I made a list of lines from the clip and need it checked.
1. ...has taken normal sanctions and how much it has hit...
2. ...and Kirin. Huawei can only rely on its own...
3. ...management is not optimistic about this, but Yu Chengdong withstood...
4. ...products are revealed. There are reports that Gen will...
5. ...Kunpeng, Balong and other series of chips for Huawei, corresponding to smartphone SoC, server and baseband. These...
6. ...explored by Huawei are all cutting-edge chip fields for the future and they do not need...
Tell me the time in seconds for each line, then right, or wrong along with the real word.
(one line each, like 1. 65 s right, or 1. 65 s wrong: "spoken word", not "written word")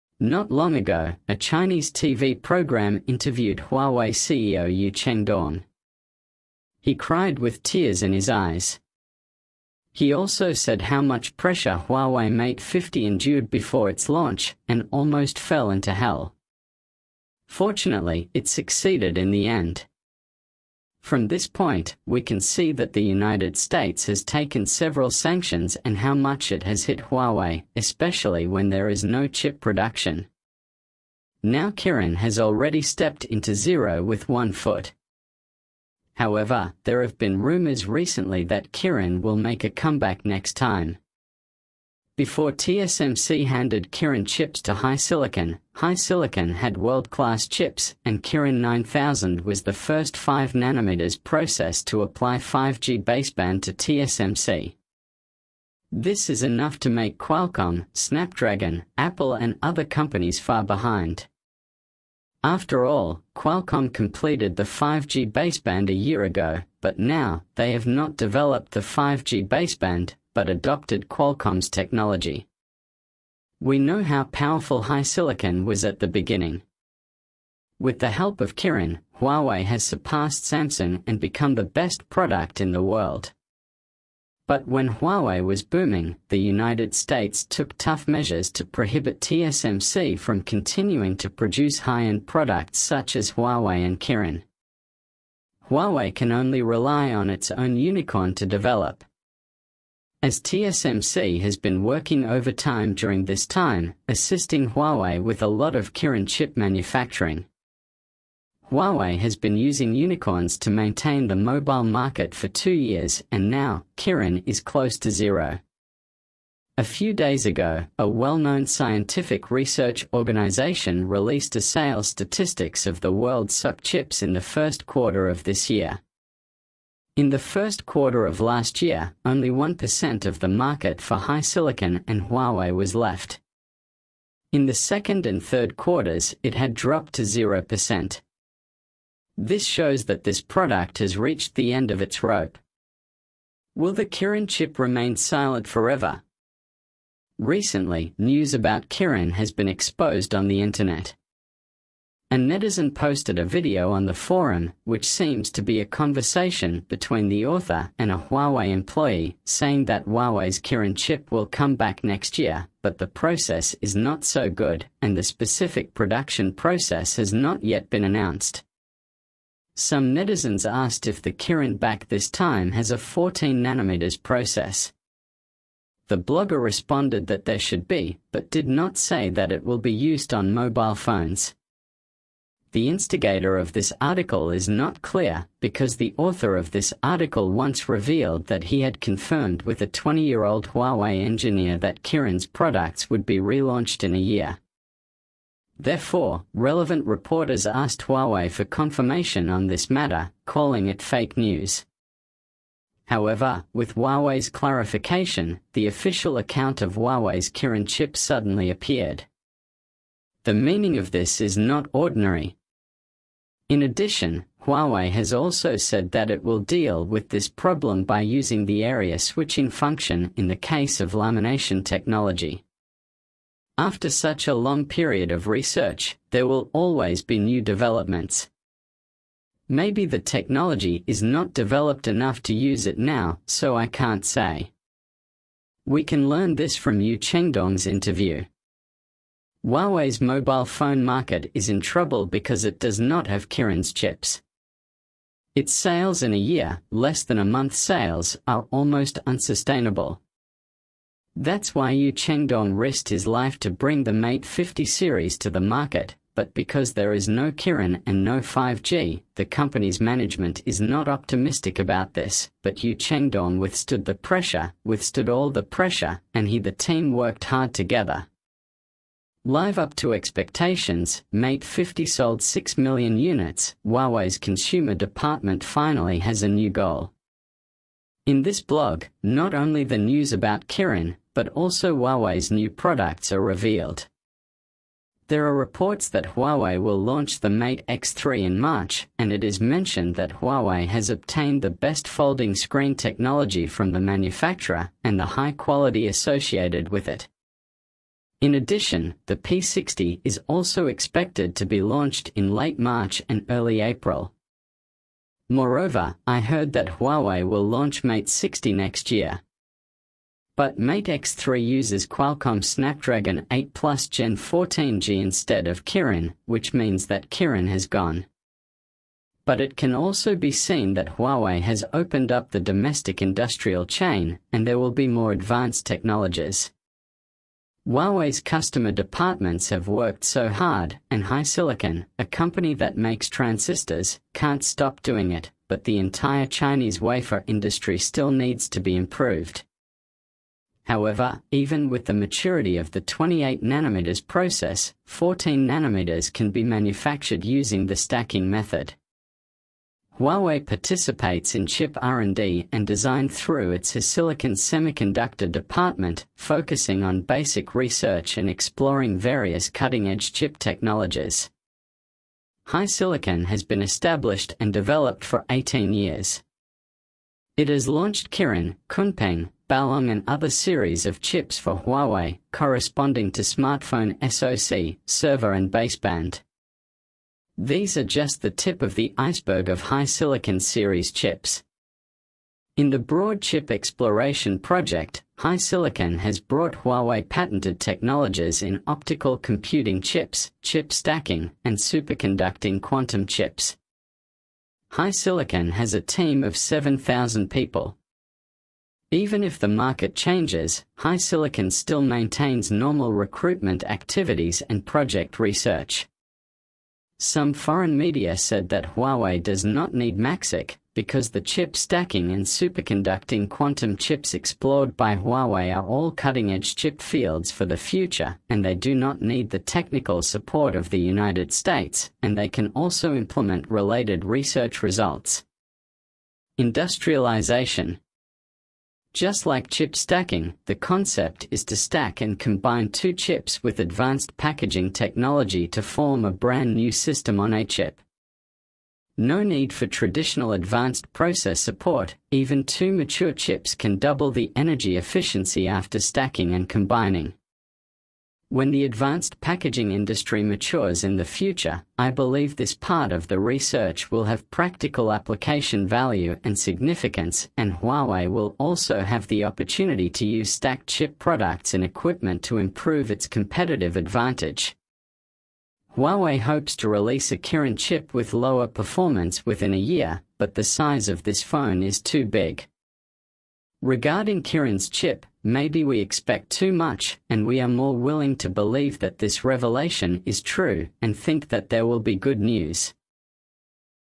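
1. 24 s wrong: "several", not "normal"
2. 93 s right
3. 260 s right
4. 282 s wrong: "Huawei", not "Gen"
5. 368 s right
6. 414 s right.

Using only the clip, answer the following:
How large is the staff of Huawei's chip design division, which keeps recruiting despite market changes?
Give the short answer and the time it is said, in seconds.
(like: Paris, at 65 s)
7,000 people, at 396 s.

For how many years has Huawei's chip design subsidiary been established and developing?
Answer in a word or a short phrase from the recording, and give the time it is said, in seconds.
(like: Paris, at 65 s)
18, at 365 s.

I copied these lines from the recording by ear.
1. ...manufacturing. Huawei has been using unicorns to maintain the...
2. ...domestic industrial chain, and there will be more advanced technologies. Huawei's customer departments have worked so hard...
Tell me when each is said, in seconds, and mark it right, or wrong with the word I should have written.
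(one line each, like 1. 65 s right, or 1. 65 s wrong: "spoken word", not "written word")
1. 106 s right
2. 322 s right.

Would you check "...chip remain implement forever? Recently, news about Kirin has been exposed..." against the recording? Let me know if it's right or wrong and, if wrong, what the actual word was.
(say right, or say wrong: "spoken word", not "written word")
wrong: "silent", not "implement".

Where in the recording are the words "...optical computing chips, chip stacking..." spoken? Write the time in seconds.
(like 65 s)
388 s.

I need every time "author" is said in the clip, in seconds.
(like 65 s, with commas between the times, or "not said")
157 s, 186 s.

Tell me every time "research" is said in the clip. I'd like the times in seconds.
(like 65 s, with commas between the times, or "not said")
119 s, 225 s, 357 s, 405 s, 424 s, 453 s.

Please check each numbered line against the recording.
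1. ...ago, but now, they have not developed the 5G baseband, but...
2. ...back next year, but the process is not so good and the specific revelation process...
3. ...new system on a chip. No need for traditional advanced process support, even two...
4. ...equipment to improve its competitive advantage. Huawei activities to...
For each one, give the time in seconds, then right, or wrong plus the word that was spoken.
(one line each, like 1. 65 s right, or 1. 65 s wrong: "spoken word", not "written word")
1. 66 s right
2. 161 s wrong: "production", not "revelation"
3. 436 s right
4. 461 s wrong: "hopes", not "activities".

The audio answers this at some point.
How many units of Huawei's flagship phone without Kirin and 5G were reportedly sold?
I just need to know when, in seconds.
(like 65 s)
272 s.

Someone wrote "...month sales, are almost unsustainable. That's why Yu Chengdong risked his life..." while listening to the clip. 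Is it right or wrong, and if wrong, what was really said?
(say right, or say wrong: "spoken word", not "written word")
right.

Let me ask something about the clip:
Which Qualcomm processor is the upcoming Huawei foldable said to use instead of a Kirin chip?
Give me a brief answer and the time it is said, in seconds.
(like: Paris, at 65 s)
Snapdragon 8 Plus Gen 1, at 312 s.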